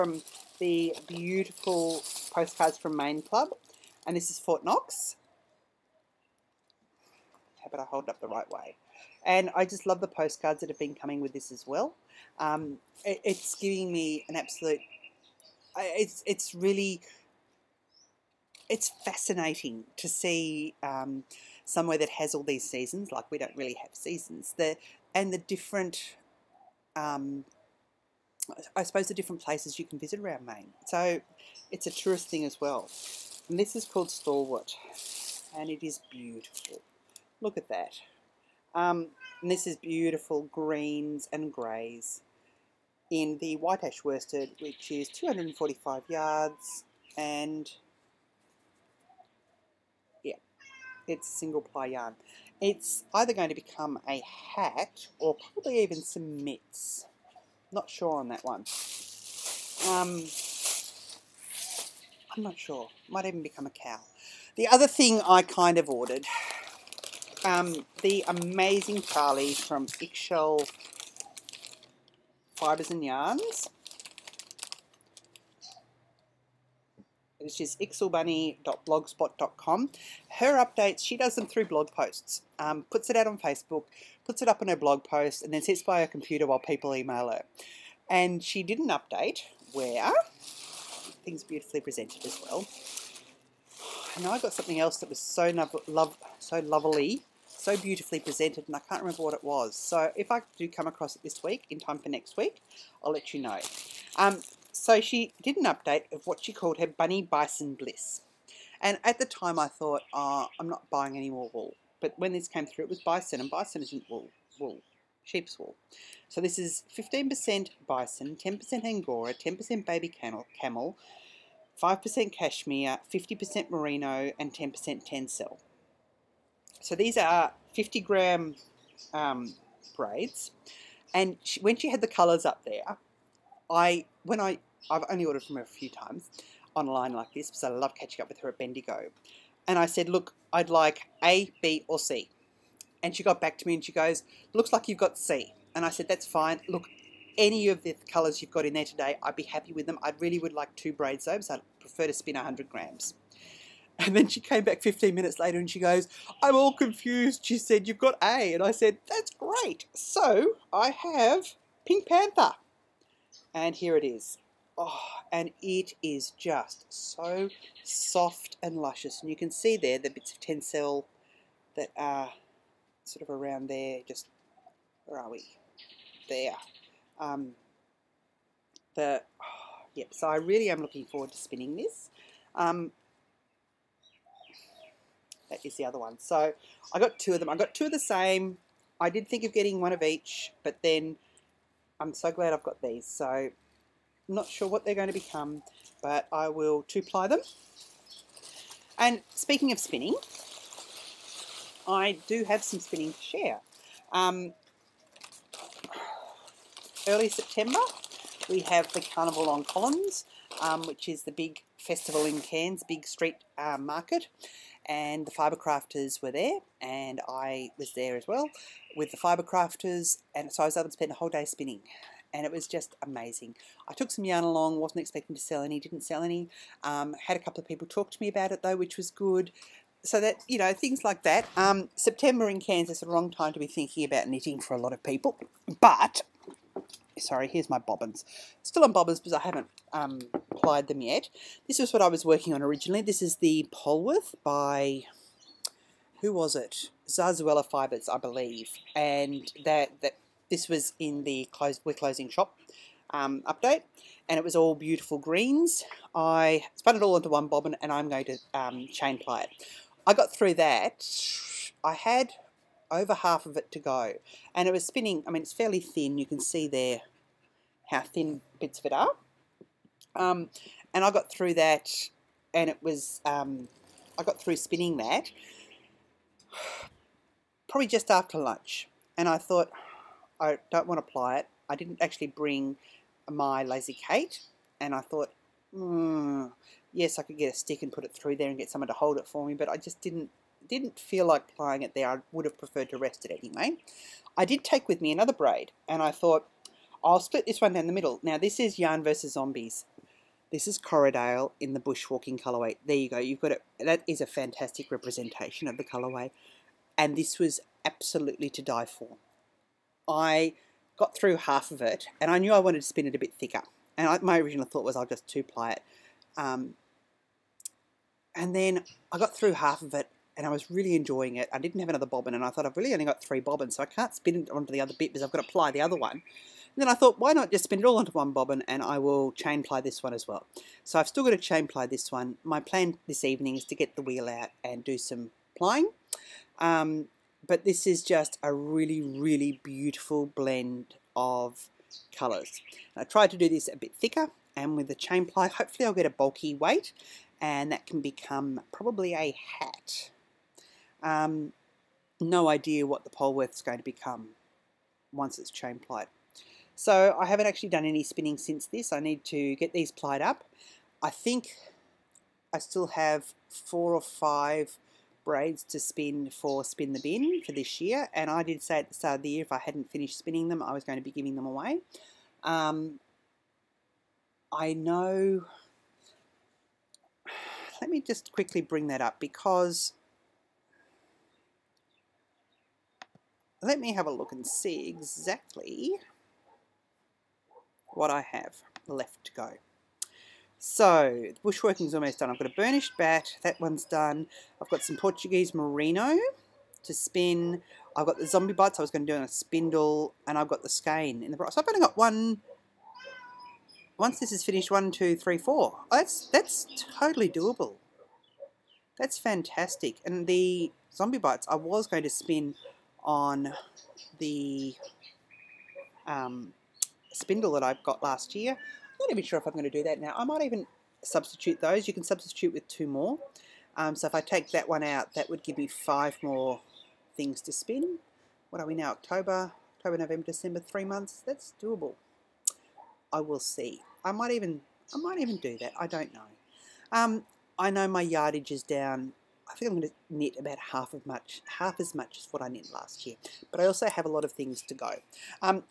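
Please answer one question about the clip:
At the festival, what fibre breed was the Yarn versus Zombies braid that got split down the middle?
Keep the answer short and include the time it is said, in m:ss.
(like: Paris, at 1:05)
Corriedale, at 5:00.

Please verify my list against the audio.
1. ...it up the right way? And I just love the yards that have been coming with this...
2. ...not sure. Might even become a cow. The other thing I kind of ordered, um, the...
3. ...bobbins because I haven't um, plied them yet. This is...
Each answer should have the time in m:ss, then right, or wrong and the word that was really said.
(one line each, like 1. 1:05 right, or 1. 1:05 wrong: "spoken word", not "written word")
1. 0:08 wrong: "postcards", not "yards"
2. 1:02 right
3. 3:58 right.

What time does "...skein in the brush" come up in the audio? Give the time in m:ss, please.
6:40.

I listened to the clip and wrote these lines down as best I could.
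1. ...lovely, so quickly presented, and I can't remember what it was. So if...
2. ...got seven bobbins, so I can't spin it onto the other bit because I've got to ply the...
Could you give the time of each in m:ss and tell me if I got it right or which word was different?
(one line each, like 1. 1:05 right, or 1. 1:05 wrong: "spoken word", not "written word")
1. 1:36 wrong: "beautifully", not "quickly"
2. 5:23 wrong: "three", not "seven".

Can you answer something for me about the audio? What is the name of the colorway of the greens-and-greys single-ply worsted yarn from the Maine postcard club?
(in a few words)
Stalwart.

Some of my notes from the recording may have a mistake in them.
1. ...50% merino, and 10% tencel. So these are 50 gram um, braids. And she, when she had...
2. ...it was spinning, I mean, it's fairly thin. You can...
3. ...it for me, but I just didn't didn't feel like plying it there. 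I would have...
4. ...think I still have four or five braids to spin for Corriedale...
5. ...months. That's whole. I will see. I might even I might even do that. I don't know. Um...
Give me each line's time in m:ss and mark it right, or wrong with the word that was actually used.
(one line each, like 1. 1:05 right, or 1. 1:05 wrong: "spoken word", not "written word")
1. 2:03 right
2. 4:24 right
3. 4:49 right
4. 6:01 wrong: "Spin", not "Corriedale"
5. 7:10 wrong: "doable", not "whole".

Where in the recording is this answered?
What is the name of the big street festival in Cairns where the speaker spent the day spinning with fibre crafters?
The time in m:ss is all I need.
3:29.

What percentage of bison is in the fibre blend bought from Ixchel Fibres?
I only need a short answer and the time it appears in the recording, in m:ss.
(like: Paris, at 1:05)
15%, at 1:56.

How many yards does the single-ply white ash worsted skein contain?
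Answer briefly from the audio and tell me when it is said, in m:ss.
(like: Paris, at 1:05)
245, at 0:45.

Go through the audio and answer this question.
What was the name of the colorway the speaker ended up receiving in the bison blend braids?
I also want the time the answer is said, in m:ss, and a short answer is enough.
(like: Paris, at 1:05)
Pink Panther, at 2:41.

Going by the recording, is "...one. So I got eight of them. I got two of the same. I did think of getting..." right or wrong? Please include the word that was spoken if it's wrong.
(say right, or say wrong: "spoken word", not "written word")
wrong: "two", not "eight".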